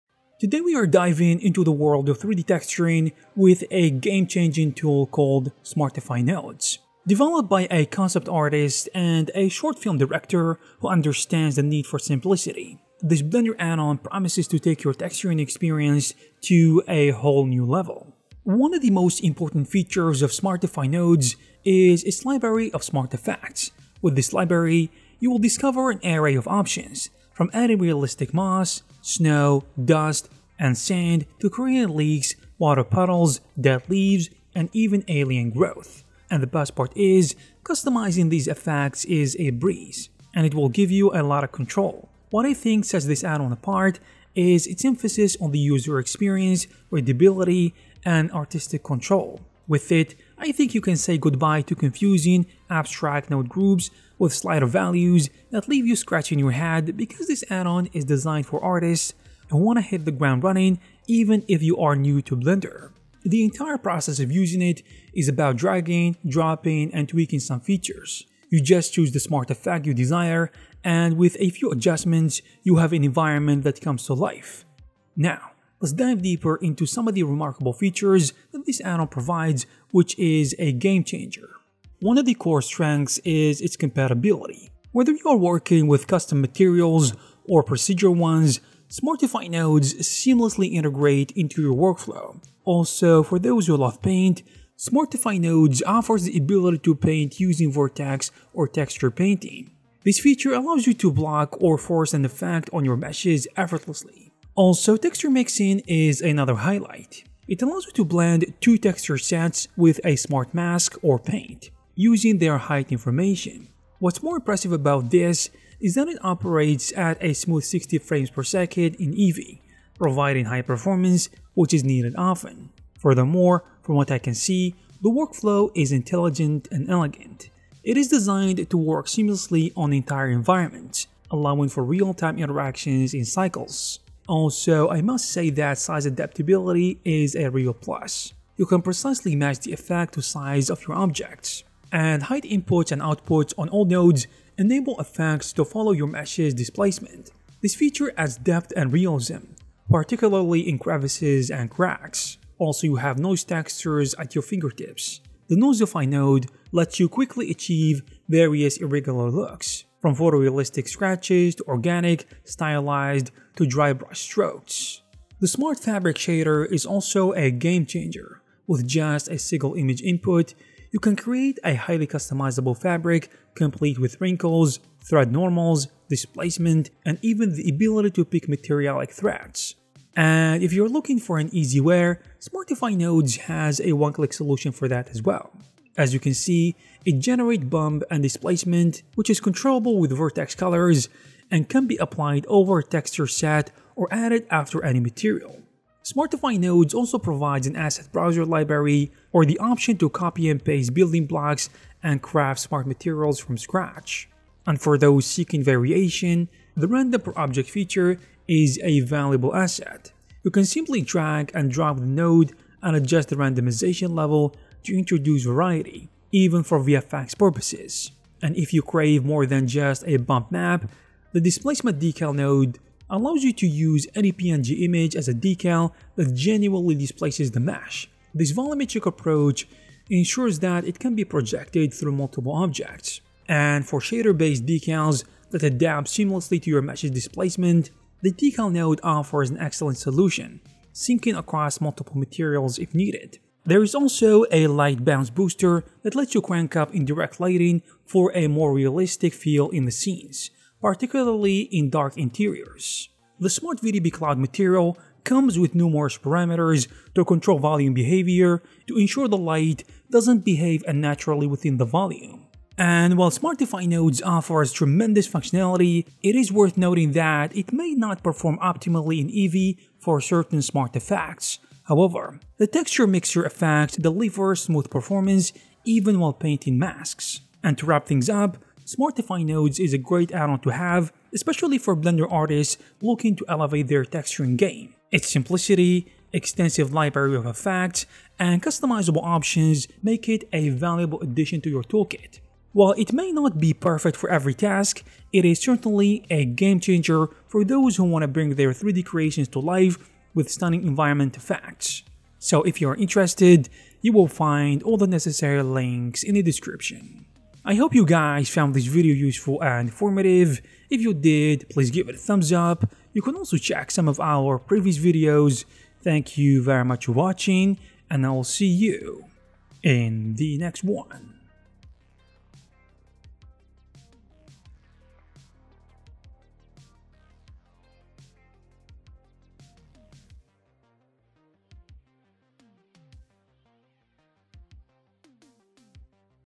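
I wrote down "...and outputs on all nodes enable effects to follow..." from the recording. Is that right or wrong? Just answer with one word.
right.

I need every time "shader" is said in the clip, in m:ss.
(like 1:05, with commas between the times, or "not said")
2:46, 3:53.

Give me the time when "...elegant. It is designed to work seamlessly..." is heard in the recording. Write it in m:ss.
2:06.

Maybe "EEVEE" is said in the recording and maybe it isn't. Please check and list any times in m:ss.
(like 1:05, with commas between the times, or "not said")
1:59, 4:29.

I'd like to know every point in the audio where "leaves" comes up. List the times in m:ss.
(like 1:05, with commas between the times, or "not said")
0:33, 0:55.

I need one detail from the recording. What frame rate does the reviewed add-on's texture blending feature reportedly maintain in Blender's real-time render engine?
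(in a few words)
60 frames per second.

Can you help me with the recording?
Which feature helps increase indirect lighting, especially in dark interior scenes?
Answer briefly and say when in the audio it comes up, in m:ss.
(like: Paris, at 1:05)
light bounce booster, at 4:04.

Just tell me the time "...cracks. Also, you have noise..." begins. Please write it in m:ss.
2:31.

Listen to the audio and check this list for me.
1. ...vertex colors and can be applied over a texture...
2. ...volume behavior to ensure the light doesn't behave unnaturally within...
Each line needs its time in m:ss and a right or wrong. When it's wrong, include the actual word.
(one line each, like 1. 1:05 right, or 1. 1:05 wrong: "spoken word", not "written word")
1. 3:10 right
2. 4:17 right.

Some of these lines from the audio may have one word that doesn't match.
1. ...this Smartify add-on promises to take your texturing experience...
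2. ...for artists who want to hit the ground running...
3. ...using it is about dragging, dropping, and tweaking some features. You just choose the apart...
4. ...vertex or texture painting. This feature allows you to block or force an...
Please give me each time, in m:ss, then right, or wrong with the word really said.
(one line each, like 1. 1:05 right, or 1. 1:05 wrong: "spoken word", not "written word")
1. 0:13 wrong: "Blender", not "Smartify"
2. 0:58 right
3. 1:04 wrong: "smart", not "apart"
4. 1:37 right.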